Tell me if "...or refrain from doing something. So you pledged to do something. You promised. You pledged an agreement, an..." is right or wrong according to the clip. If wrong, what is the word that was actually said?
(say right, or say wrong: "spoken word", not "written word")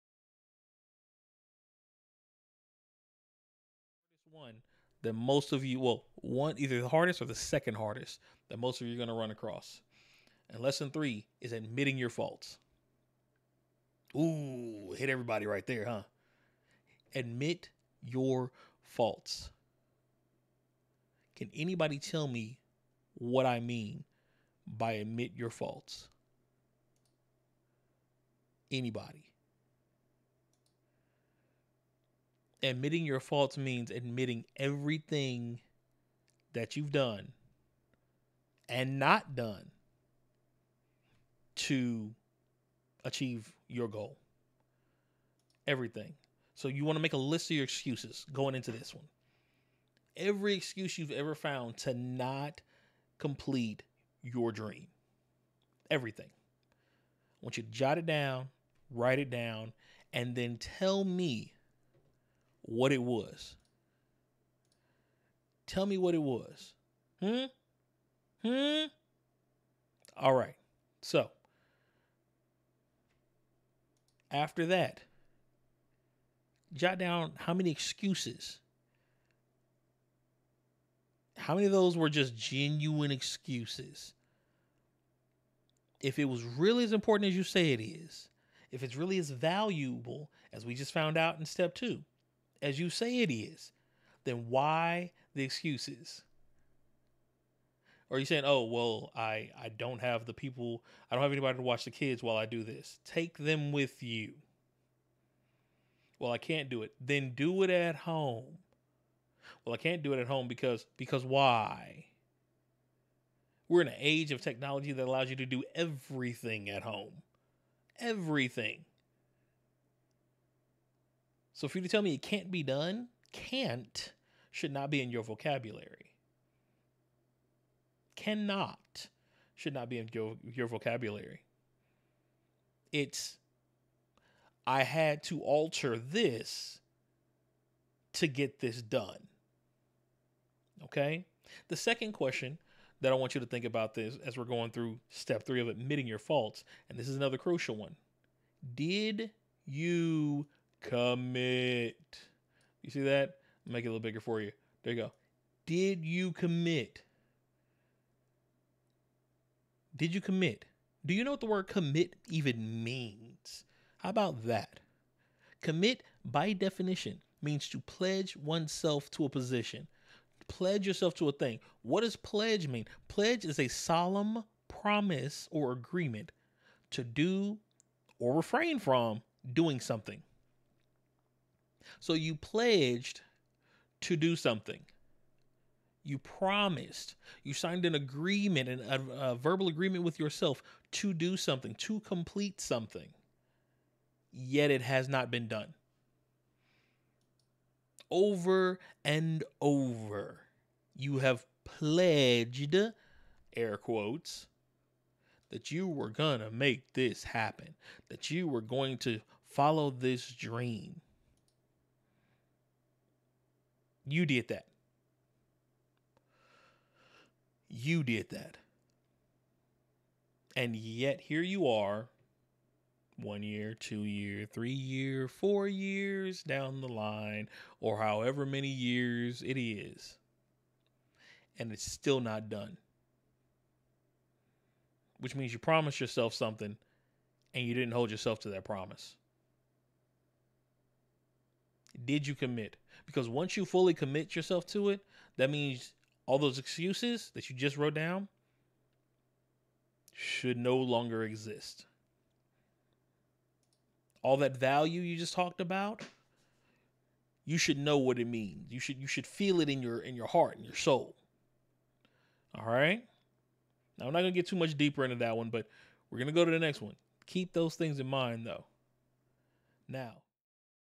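wrong: "signed", not "pledged".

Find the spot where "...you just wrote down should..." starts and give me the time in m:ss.
4:07.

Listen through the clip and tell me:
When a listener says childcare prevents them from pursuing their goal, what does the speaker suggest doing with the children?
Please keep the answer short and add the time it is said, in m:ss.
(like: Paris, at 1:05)
Take them with you, at 1:43.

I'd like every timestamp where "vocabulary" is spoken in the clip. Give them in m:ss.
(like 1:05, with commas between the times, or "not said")
2:05, 2:10.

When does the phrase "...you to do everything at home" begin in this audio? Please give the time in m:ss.
1:55.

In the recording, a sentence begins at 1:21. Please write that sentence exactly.
How many of those were just genuine excuses?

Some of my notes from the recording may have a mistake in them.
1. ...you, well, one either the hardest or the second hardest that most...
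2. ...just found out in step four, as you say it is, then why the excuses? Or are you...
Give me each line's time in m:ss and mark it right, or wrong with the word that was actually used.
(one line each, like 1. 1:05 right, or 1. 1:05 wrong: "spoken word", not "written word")
1. 0:05 right
2. 1:30 wrong: "two", not "four".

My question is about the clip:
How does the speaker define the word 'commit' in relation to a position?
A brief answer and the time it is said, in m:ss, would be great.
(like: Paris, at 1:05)
pledge oneself, at 2:47.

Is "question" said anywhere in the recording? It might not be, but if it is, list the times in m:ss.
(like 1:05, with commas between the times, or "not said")
2:22.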